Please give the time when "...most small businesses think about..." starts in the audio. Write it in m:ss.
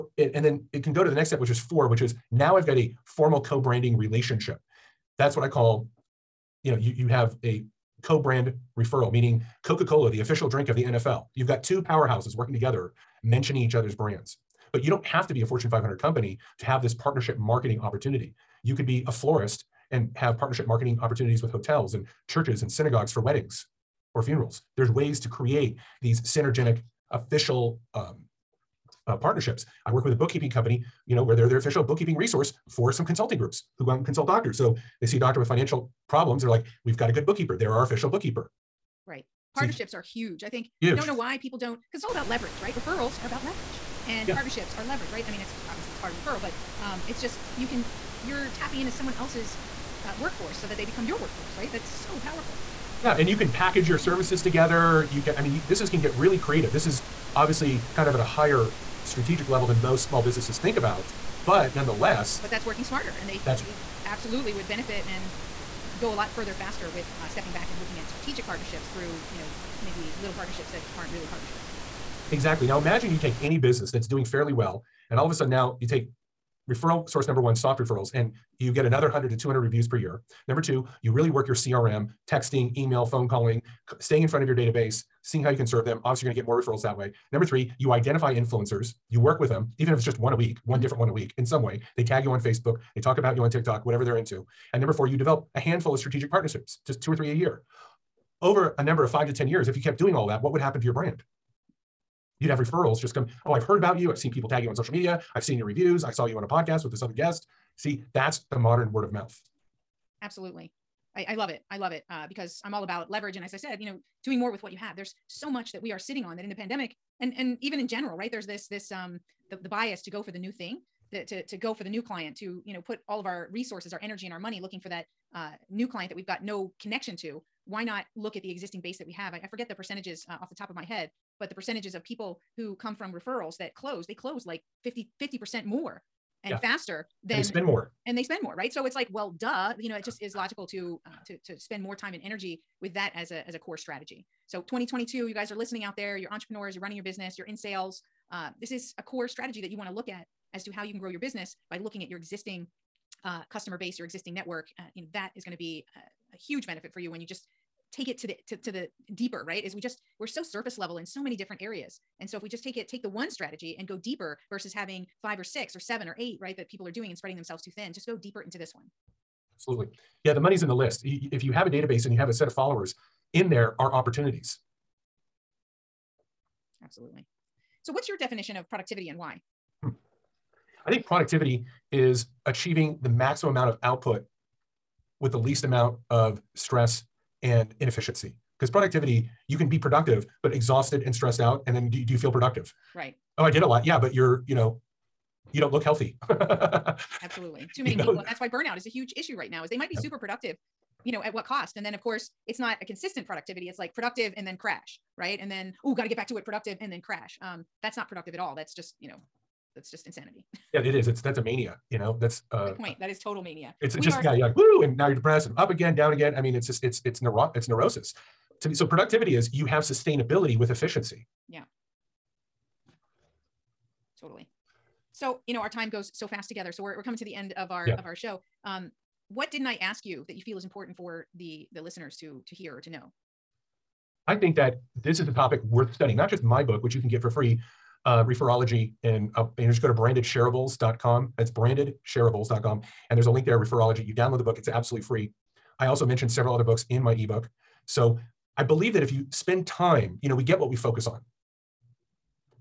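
0:59.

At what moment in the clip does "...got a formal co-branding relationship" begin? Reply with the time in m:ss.
0:02.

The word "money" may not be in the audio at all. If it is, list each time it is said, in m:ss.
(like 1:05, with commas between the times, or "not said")
2:04, 2:50.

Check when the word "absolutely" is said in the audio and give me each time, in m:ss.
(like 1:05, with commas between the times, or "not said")
1:04, 1:50, 2:49, 2:56, 3:17, 4:04.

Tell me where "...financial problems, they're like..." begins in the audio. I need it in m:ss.
0:35.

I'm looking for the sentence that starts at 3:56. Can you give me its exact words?
Not just my book, which you can get for free, uh, referology, and, you uh, just go to brandedshareables.com.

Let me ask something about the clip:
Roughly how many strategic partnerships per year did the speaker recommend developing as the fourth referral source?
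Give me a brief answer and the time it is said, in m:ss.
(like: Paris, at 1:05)
2 or 3, at 1:37.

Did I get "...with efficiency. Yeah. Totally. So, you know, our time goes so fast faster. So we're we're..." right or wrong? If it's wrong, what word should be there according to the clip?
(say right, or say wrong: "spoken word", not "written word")
wrong: "together", not "faster".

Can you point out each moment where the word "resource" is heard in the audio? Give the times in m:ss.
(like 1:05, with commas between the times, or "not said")
0:32, 2:03.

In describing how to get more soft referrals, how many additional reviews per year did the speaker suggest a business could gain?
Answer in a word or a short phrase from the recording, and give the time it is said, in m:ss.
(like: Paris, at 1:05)
100 to 200, at 1:19.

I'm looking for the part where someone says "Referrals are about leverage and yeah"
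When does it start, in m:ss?
0:42.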